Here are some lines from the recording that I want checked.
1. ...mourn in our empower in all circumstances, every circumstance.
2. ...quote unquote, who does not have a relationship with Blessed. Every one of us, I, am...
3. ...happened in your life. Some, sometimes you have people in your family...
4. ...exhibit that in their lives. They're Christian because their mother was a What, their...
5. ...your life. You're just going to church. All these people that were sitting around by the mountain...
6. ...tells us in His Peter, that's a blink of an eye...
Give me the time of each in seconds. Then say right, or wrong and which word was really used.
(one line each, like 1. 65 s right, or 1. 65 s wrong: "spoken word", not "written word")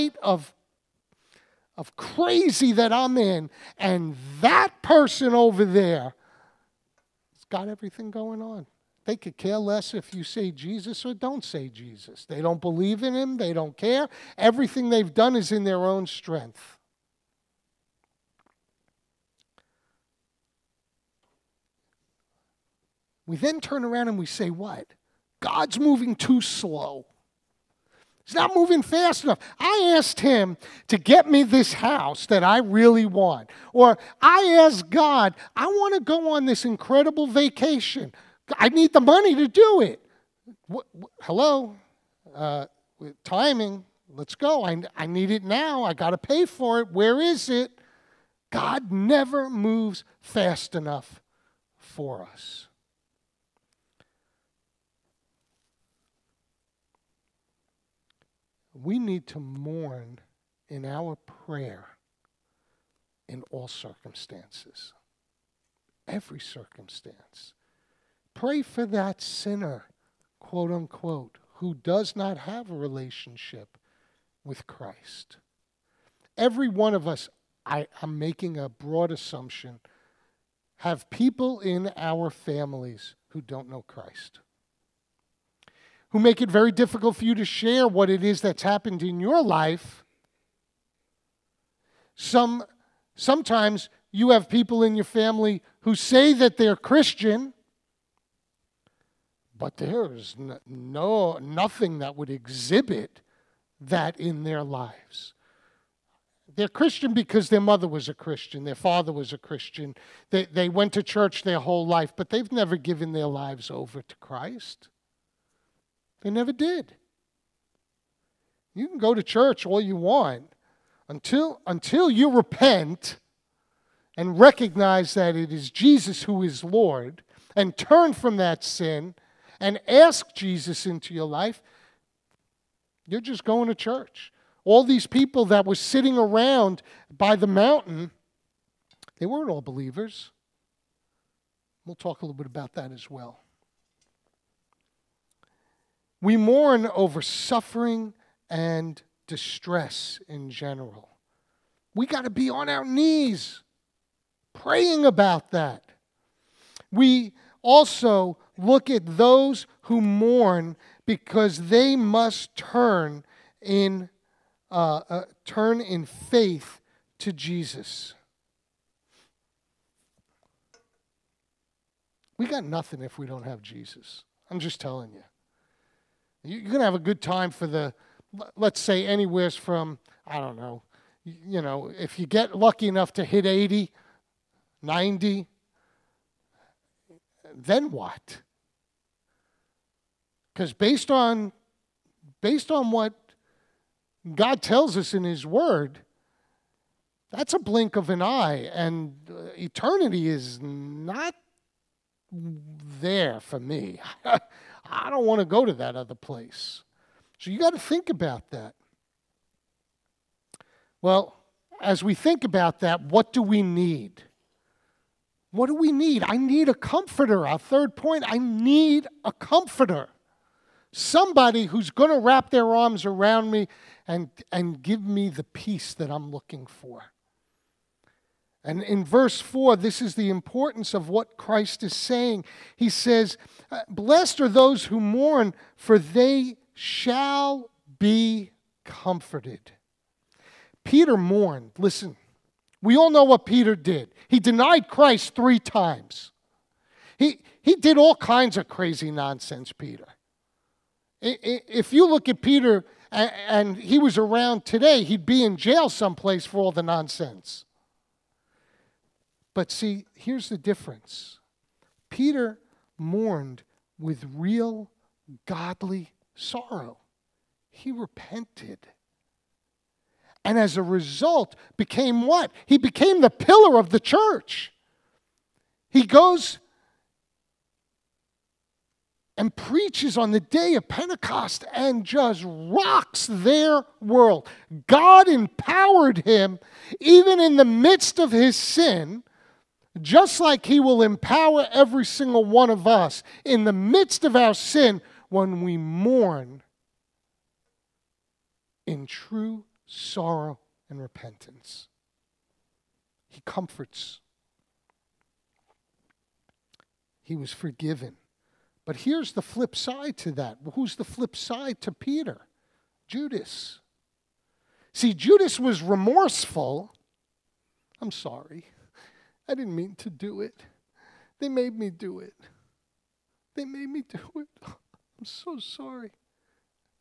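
1. 59 s wrong: "prayer", not "empower"
2. 70 s wrong: "Christ", not "Blessed"
3. 88 s right
4. 102 s wrong: "Christian", not "What"
5. 131 s right
6. 194 s wrong: "Word", not "Peter".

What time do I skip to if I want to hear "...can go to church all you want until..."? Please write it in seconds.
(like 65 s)
118 s.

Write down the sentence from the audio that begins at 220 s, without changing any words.
Somebody who's going to wrap their arms around me and, and give me the peace that I'm looking for.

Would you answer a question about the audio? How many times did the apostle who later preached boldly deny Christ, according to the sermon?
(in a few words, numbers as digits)
3.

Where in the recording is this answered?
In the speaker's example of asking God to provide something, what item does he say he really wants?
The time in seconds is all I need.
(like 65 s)
31 s.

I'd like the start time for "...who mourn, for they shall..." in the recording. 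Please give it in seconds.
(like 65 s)
234 s.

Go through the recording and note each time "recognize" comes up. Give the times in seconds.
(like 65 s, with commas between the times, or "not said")
124 s.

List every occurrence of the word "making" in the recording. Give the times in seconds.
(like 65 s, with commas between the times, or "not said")
78 s.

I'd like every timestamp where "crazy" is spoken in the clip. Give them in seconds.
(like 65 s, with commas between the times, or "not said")
1 s, 248 s.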